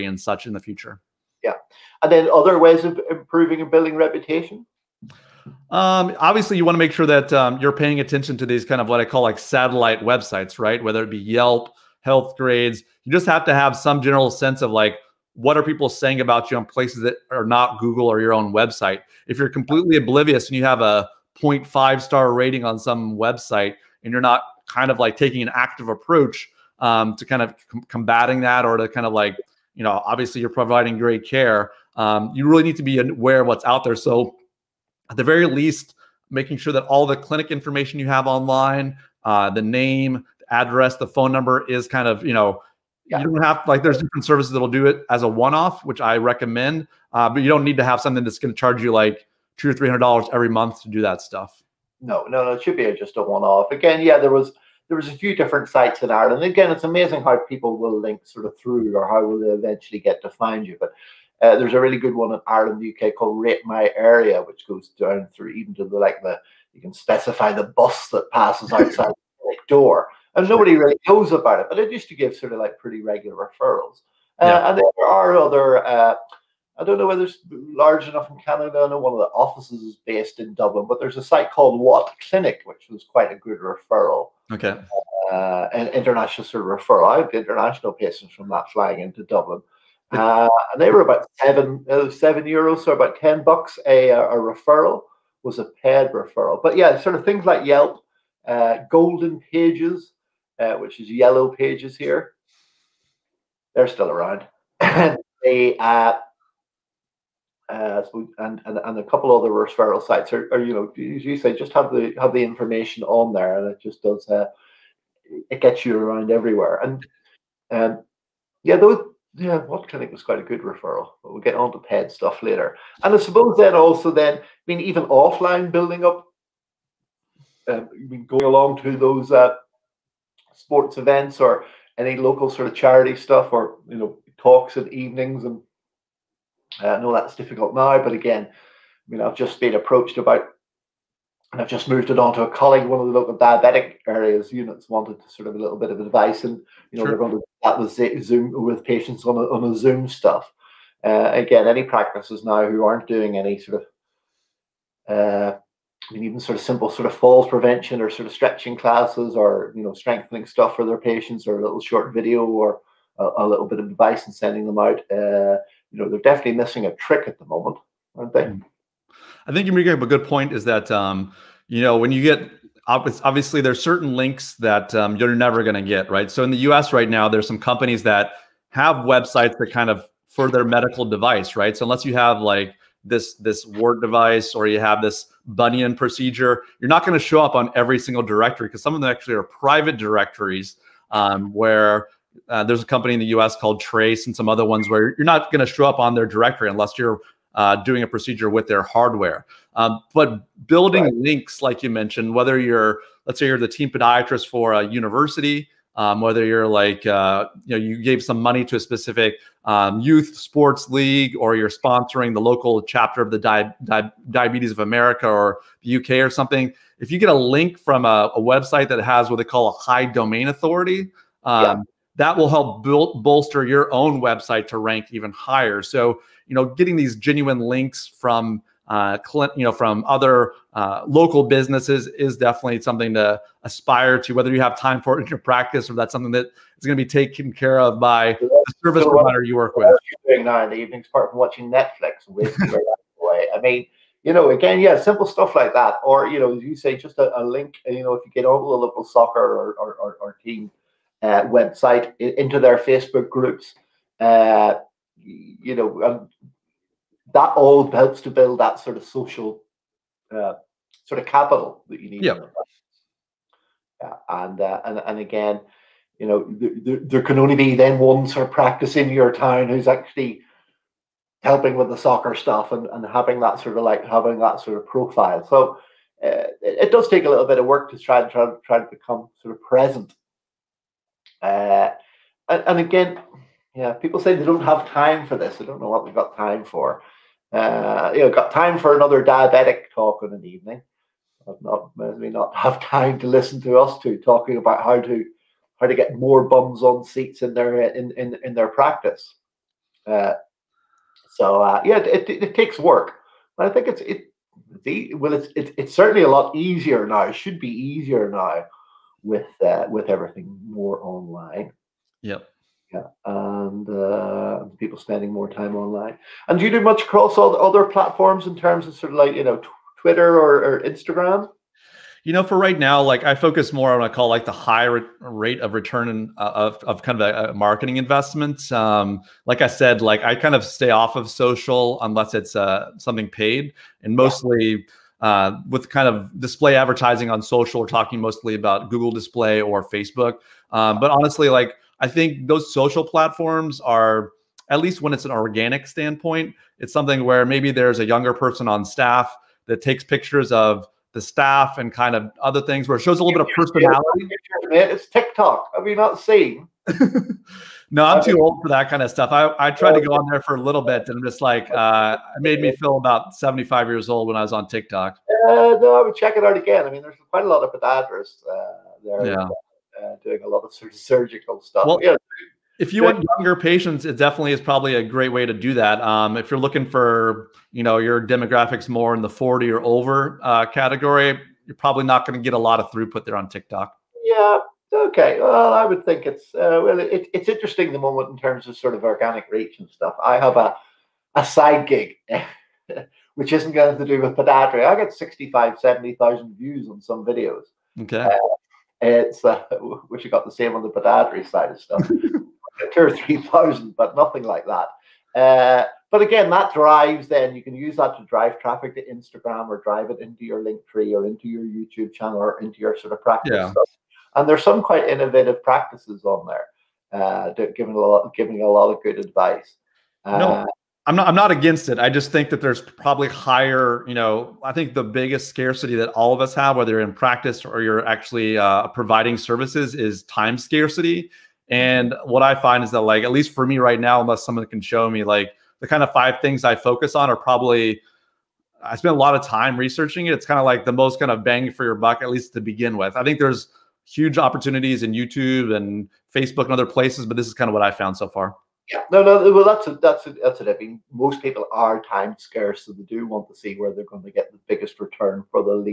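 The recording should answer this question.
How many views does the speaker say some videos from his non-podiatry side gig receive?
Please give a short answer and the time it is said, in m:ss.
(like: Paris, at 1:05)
65,000 to 70,000, at 6:35.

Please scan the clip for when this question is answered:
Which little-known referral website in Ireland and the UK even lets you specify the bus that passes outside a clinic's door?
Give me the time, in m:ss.
1:03.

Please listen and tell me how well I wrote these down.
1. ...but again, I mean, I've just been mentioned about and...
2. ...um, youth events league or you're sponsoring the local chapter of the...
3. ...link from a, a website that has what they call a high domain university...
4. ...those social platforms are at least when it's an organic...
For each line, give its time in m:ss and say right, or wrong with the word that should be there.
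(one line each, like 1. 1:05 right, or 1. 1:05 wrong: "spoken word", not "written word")
1. 2:18 wrong: "approached", not "mentioned"
2. 3:29 wrong: "sports", not "events"
3. 3:37 wrong: "authority", not "university"
4. 5:42 right.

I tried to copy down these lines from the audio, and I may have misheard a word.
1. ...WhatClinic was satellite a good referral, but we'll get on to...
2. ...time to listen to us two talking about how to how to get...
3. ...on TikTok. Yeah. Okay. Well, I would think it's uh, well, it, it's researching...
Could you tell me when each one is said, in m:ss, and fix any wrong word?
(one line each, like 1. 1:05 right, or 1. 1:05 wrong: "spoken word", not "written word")
1. 1:59 wrong: "quite", not "satellite"
2. 4:52 right
3. 6:23 wrong: "interesting", not "researching".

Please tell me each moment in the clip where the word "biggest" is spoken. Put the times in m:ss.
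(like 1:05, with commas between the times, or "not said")
7:05, 7:34.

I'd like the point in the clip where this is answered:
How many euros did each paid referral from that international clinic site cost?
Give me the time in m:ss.
1:32.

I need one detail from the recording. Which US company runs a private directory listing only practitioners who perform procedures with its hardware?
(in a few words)
Trace.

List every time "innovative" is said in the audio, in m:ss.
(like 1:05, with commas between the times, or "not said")
6:55.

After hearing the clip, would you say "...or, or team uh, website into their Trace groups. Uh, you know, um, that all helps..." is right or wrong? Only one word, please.
wrong.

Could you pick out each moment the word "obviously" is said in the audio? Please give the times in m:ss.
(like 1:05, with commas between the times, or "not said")
0:06, 0:30, 2:52.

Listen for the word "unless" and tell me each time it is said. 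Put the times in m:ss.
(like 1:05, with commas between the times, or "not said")
3:01, 3:16, 5:32, 7:14.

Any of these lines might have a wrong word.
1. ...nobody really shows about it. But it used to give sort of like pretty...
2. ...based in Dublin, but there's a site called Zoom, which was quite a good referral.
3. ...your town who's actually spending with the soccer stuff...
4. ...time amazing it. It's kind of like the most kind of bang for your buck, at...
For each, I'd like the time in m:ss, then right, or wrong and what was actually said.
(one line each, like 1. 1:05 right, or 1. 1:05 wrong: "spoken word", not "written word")
1. 1:10 wrong: "knows", not "shows"
2. 1:20 wrong: "WhatClinic", not "Zoom"
3. 4:29 wrong: "helping", not "spending"
4. 7:19 wrong: "researching", not "amazing".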